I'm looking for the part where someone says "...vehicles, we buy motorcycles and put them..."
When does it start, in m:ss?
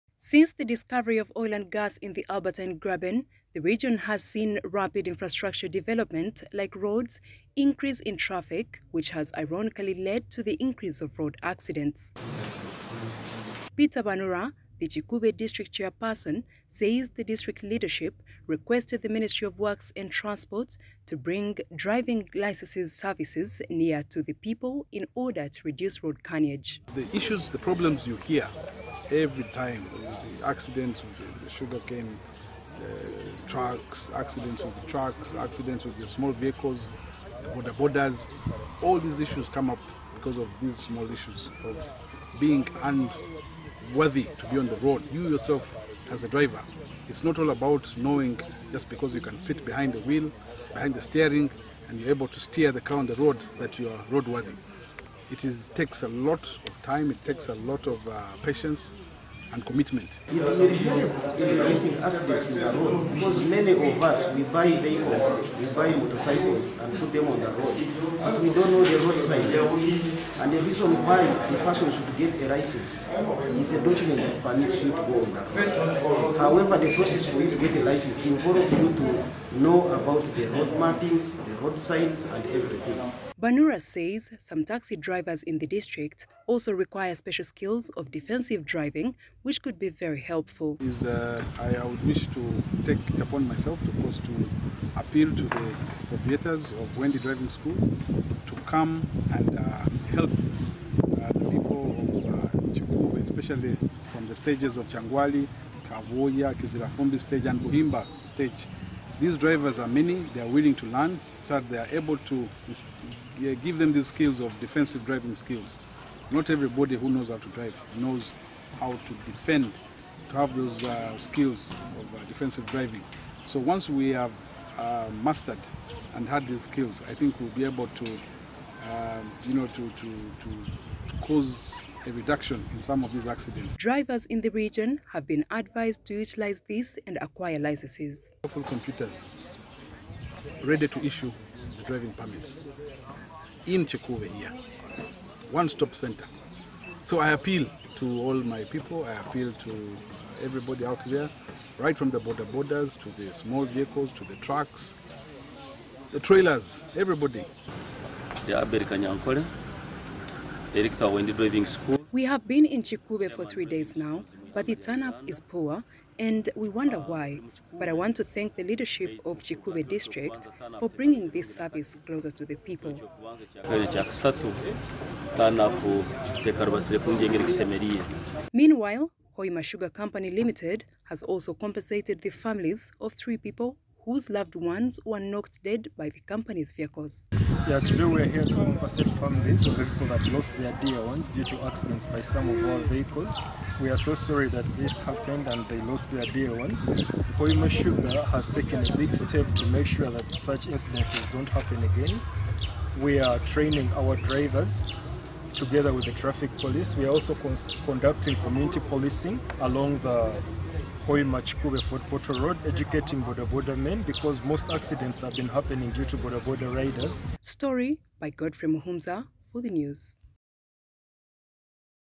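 1:04.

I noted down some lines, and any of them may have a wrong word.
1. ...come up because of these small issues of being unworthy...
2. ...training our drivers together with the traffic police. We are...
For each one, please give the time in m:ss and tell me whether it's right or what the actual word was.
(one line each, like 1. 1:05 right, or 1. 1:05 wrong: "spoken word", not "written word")
1. 0:39 right
2. 3:23 right.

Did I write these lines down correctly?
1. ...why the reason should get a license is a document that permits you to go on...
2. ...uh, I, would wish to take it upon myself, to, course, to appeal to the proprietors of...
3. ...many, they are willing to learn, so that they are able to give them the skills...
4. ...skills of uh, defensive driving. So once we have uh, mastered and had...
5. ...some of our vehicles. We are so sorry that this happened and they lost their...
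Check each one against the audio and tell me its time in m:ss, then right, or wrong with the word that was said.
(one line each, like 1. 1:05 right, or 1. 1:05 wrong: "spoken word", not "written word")
1. 1:11 wrong: "person", not "reason"
2. 1:31 right
3. 1:49 right
4. 2:01 right
5. 3:12 right.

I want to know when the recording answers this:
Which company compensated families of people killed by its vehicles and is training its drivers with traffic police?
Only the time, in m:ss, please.
2:59.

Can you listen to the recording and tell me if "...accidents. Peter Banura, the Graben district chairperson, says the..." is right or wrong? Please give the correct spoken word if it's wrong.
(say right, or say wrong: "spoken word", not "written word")
wrong: "Kikuube", not "Graben".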